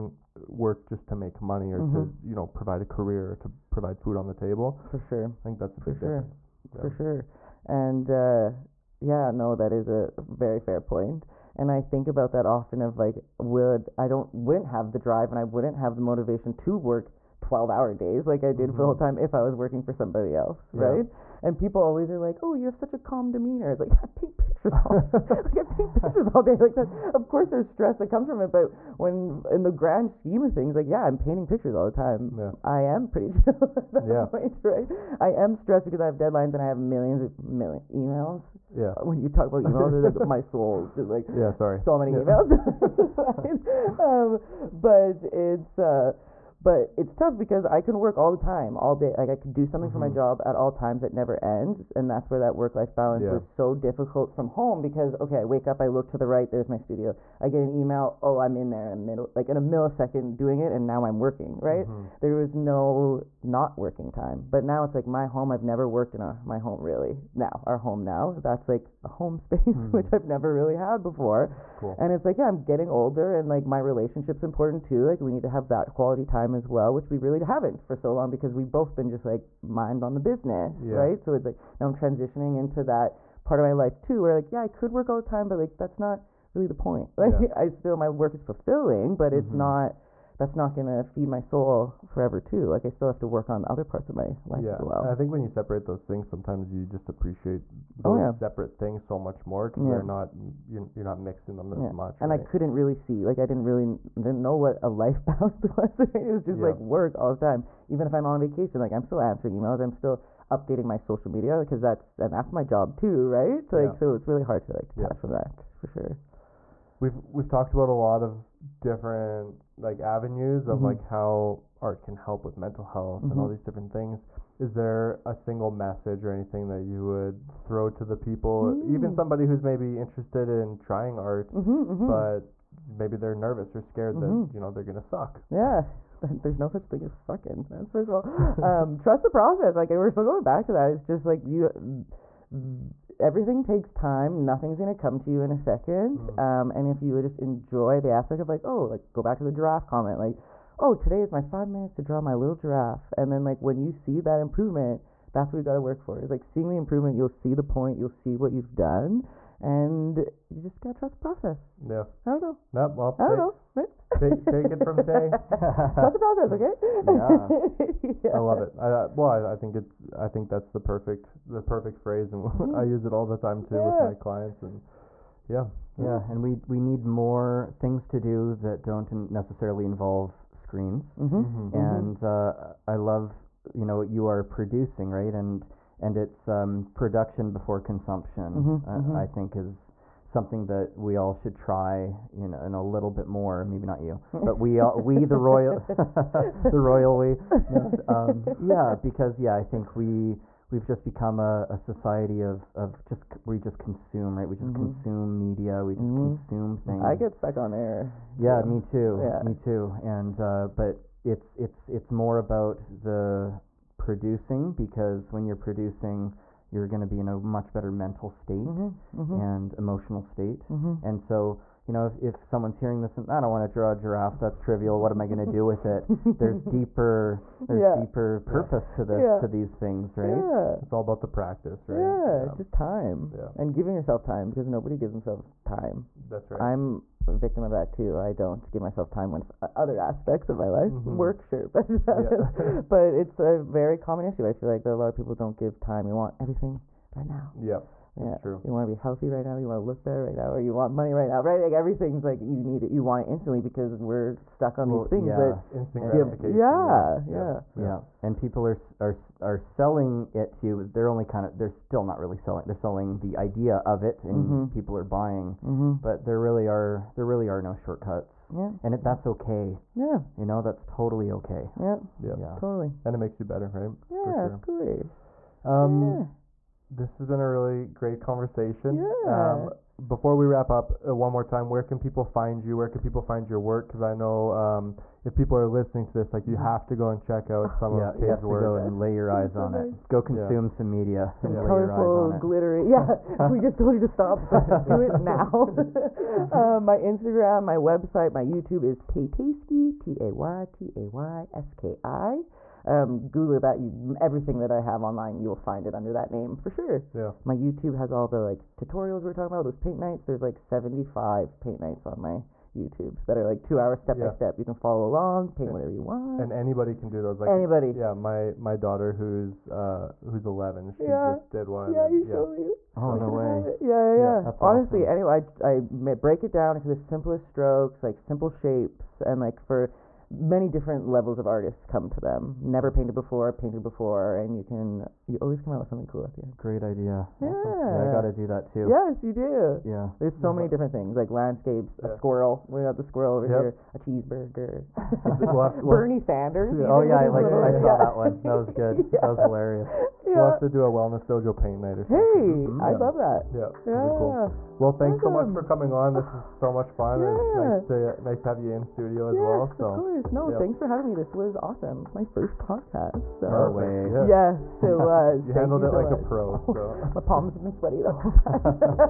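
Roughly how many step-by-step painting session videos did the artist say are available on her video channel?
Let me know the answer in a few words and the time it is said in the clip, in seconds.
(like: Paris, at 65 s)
75, at 310 s.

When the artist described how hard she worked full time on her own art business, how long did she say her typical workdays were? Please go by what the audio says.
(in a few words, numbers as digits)
12 hours.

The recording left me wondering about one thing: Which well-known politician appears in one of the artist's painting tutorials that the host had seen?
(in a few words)
Bernie Sanders.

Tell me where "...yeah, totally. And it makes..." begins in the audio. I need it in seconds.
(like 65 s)
272 s.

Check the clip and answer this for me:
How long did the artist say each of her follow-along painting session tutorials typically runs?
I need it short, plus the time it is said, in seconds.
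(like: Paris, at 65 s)
two hours, at 313 s.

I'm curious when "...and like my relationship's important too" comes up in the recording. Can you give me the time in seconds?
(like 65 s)
73 s.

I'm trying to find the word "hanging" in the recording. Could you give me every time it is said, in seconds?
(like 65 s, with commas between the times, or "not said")
not said.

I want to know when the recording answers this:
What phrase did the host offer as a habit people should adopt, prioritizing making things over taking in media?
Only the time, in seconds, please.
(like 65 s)
186 s.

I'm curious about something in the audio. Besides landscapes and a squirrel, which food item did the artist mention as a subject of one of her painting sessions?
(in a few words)
cheeseburger.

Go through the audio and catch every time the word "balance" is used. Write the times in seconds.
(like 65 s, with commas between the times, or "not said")
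52 s, 105 s.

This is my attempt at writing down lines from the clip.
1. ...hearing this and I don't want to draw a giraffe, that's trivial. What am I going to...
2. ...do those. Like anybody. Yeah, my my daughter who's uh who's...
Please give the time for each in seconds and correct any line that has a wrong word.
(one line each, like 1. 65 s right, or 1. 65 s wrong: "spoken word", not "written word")
1. 222 s right
2. 317 s right.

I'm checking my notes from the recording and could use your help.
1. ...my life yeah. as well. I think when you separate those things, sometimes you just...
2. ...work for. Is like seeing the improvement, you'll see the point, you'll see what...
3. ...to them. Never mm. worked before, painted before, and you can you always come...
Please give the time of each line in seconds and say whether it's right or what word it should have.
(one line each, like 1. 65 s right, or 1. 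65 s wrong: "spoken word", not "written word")
1. 94 s right
2. 155 s right
3. 332 s wrong: "painted", not "worked".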